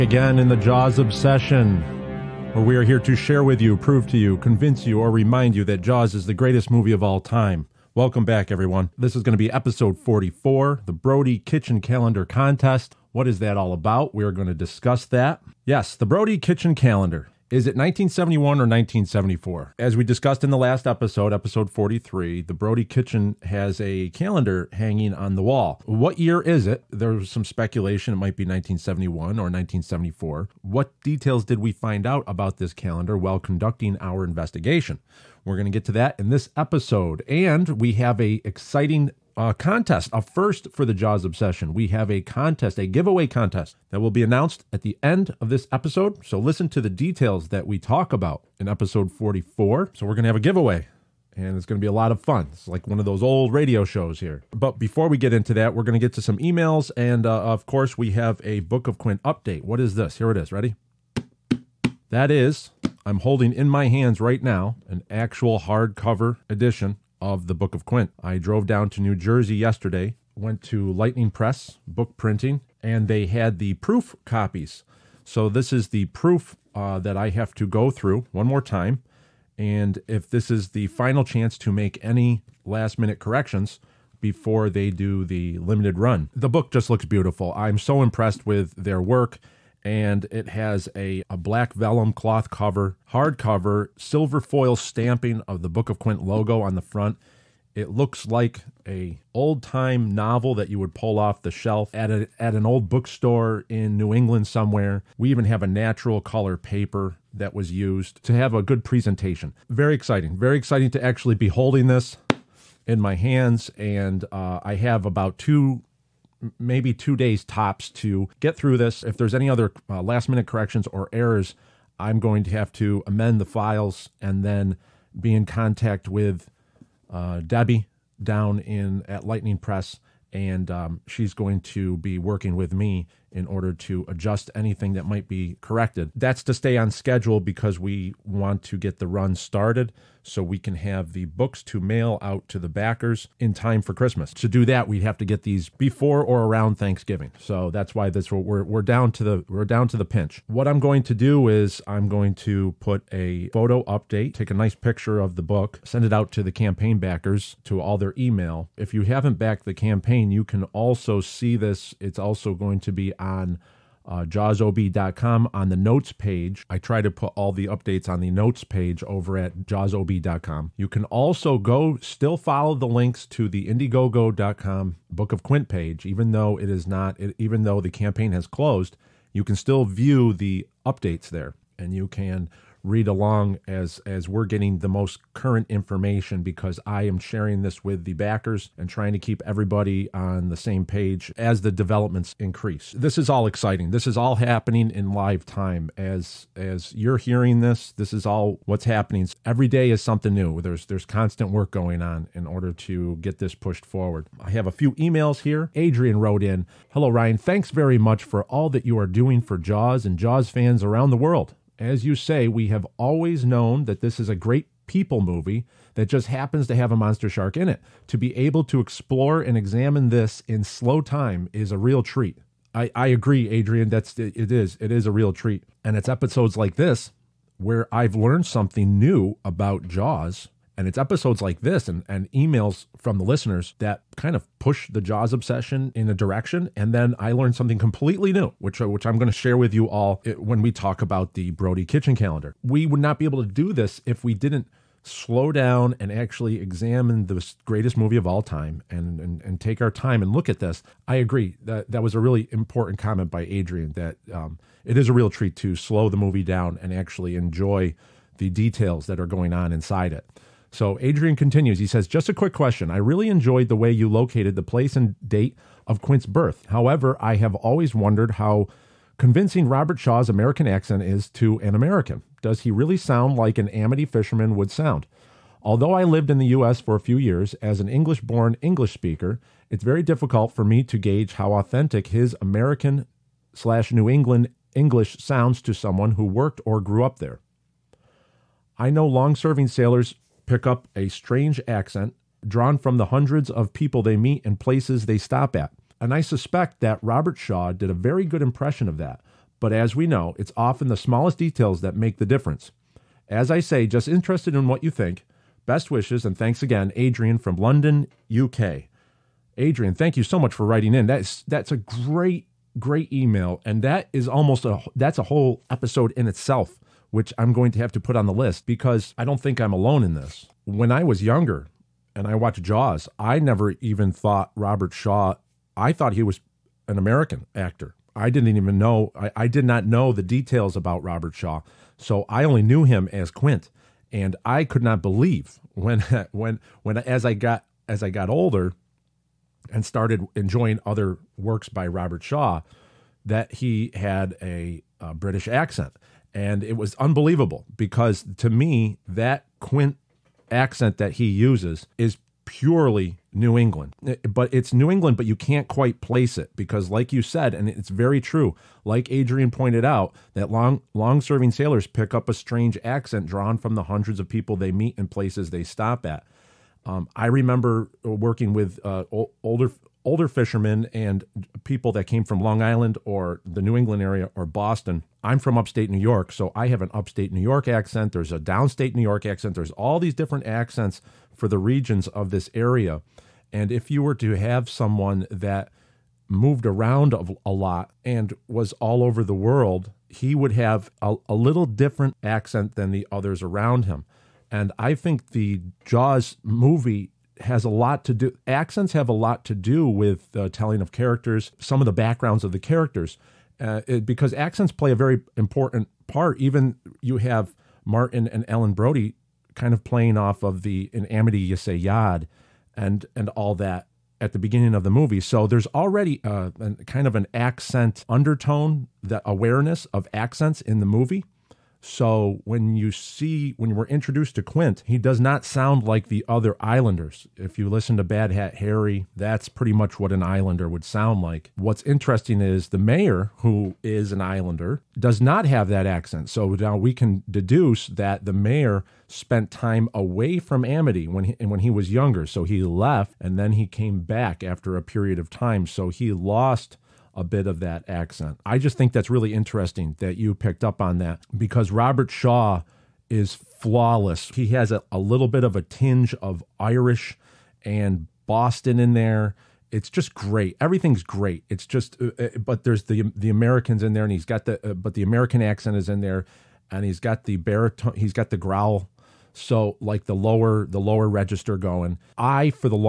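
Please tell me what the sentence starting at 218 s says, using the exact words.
To be able to explore and examine this in slow time is a real treat.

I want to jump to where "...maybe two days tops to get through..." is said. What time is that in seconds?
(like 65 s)
116 s.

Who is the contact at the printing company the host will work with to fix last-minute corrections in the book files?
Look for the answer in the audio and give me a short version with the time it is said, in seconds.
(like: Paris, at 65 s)
Debbie, at 127 s.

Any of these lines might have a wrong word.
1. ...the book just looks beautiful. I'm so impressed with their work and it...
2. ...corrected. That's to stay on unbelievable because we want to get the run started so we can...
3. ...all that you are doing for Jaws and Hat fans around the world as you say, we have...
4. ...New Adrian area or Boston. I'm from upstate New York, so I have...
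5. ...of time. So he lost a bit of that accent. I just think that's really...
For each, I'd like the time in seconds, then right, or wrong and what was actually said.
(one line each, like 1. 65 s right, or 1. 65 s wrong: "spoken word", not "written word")
1. 86 s right
2. 135 s wrong: "schedule", not "unbelievable"
3. 208 s wrong: "Jaws", not "Hat"
4. 373 s wrong: "England", not "Adrian"
5. 445 s right.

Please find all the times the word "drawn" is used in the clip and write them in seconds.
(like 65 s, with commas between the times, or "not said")
292 s, 363 s.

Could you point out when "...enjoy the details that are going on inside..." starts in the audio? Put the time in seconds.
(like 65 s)
257 s.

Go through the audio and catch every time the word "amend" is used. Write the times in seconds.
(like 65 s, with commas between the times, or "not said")
123 s.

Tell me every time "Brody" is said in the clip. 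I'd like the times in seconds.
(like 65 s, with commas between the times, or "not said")
10 s, 16 s, 22 s, 241 s, 408 s.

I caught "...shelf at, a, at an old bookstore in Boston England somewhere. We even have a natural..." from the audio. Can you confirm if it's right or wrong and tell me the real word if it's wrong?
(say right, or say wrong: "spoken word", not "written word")
wrong: "New", not "Boston".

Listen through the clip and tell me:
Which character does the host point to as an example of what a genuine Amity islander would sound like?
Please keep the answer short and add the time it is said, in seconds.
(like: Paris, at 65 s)
Bad Hat Harry, at 428 s.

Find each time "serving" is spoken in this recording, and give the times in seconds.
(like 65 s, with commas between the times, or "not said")
289 s, 361 s.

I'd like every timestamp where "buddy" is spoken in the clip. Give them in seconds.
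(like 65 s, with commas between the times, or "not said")
not said.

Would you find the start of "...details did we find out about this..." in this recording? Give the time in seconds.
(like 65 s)
31 s.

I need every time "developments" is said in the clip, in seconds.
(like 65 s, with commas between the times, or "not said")
191 s.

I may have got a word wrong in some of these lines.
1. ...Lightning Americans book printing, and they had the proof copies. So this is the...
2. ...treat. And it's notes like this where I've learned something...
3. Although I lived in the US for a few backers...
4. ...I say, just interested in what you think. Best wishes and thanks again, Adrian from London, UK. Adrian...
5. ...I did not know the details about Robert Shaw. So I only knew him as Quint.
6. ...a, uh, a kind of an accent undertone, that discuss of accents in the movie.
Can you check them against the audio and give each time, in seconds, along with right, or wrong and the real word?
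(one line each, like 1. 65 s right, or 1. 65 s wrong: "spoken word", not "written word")
1. 70 s wrong: "Press", not "Americans"
2. 225 s wrong: "episodes", not "notes"
3. 275 s wrong: "years", not "backers"
4. 303 s right
5. 329 s right
6. 416 s wrong: "awareness", not "discuss".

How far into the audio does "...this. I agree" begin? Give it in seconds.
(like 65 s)
250 s.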